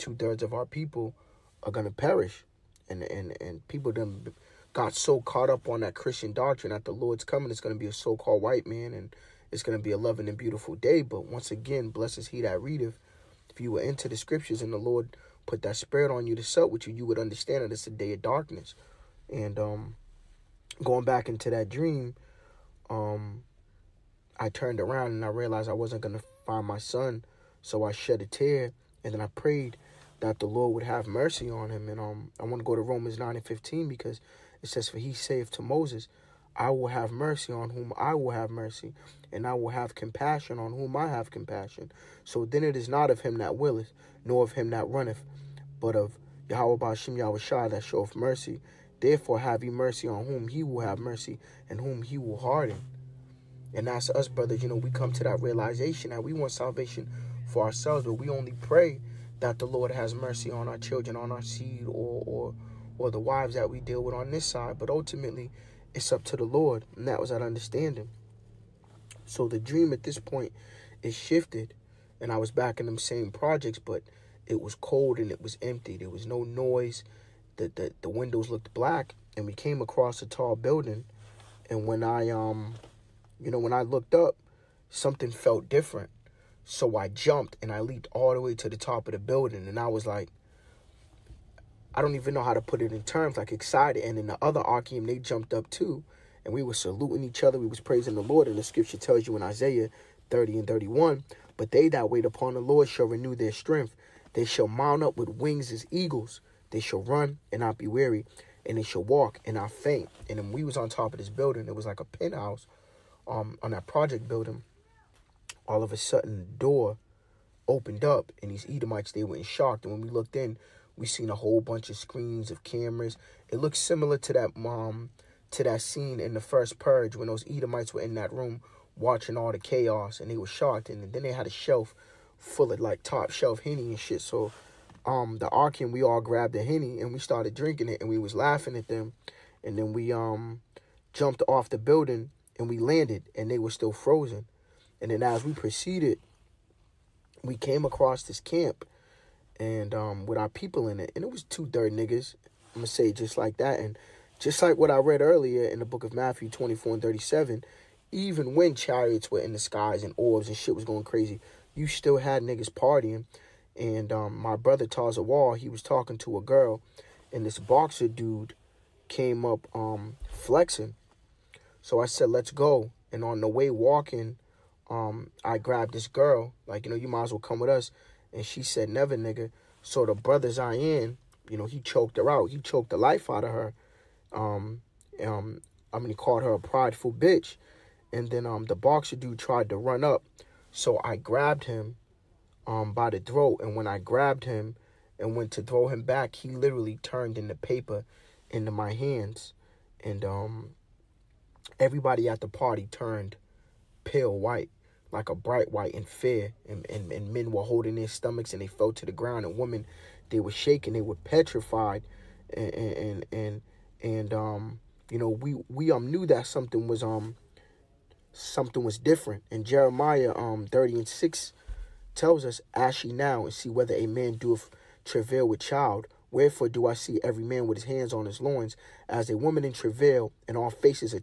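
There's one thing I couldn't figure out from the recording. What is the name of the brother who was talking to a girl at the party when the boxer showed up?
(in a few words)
Taza Wall.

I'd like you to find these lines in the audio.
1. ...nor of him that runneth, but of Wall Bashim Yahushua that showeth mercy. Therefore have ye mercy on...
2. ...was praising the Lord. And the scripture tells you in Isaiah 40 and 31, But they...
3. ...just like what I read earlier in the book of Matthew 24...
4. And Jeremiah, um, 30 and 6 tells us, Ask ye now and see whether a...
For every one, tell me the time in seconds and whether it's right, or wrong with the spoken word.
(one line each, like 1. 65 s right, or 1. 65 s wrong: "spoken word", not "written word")
1. 44 s wrong: "Yahweh", not "Wall"
2. 97 s wrong: "30", not "40"
3. 154 s right
4. 219 s right.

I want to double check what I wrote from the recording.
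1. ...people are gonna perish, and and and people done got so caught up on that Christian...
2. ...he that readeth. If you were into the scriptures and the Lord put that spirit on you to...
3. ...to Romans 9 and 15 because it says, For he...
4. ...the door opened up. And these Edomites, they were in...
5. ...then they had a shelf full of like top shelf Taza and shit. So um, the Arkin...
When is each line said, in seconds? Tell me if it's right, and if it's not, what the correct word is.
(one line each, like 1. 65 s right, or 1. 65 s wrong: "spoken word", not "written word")
1. 0 s right
2. 12 s right
3. 32 s right
4. 116 s right
5. 131 s wrong: "Henny", not "Taza".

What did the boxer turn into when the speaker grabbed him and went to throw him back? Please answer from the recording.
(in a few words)
Paper.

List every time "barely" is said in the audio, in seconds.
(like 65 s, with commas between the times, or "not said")
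not said.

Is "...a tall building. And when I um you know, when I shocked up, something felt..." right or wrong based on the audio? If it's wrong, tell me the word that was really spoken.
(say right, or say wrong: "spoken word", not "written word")
wrong: "looked", not "shocked".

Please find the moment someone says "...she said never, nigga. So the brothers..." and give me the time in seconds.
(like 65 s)
178 s.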